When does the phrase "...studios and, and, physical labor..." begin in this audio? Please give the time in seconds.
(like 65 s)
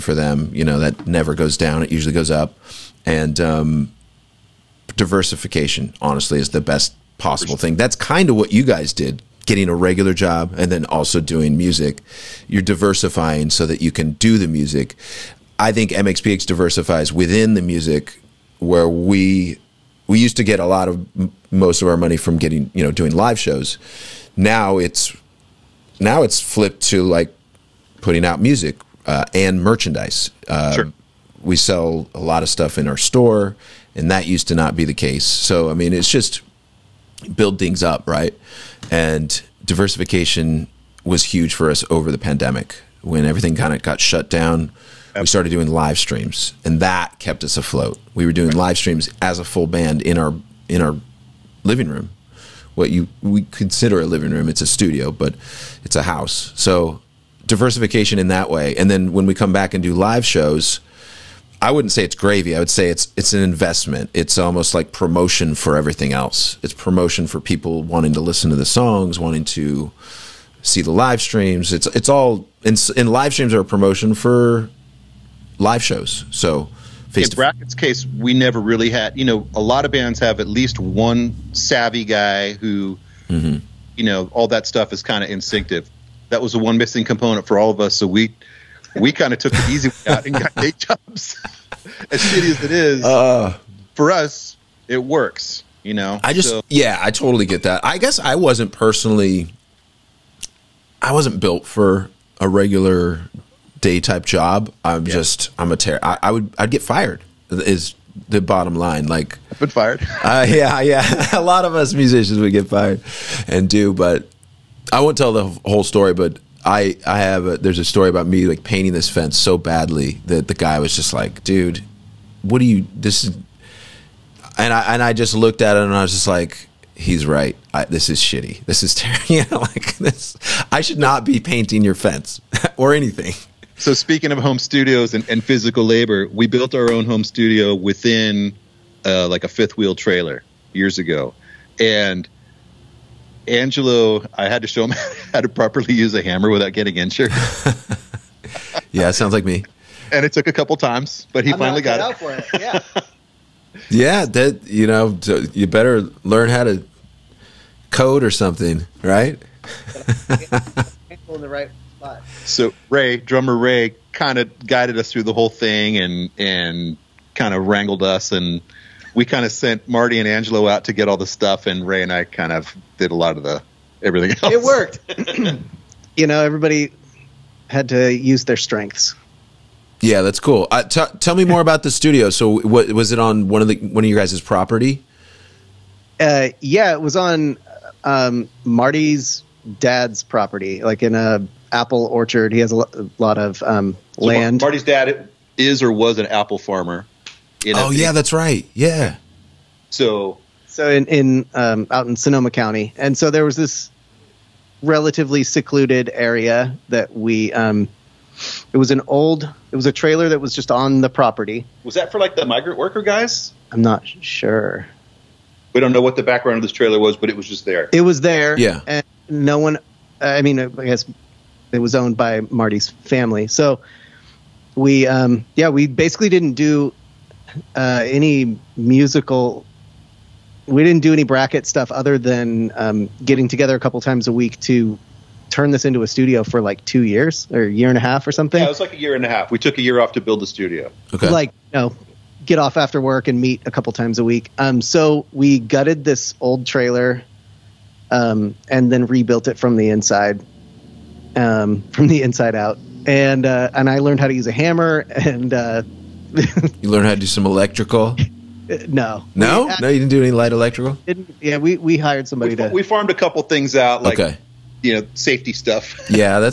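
134 s.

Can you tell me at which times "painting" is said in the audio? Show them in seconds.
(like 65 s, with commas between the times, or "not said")
118 s, 131 s.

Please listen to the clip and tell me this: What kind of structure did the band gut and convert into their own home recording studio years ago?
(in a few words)
A fifth wheel trailer.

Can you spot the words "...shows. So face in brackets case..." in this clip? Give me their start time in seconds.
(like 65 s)
75 s.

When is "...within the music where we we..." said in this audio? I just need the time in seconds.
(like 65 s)
17 s.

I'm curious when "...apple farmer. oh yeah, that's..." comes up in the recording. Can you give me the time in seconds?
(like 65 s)
196 s.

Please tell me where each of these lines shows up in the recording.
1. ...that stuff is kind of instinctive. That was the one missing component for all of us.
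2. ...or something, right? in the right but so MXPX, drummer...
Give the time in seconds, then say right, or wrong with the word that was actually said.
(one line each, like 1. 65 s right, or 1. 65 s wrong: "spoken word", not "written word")
1. 84 s right
2. 158 s wrong: "Ray", not "MXPX".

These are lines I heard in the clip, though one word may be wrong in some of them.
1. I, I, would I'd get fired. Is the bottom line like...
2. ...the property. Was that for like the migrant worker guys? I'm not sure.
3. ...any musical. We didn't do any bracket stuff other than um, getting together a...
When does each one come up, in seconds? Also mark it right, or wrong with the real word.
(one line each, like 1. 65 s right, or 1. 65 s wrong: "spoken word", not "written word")
1. 106 s right
2. 211 s right
3. 228 s right.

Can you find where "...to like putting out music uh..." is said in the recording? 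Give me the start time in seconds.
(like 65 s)
26 s.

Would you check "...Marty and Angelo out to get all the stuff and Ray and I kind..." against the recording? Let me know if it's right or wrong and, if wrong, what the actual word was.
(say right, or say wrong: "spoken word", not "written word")
right.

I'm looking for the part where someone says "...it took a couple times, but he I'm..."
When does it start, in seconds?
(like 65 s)
150 s.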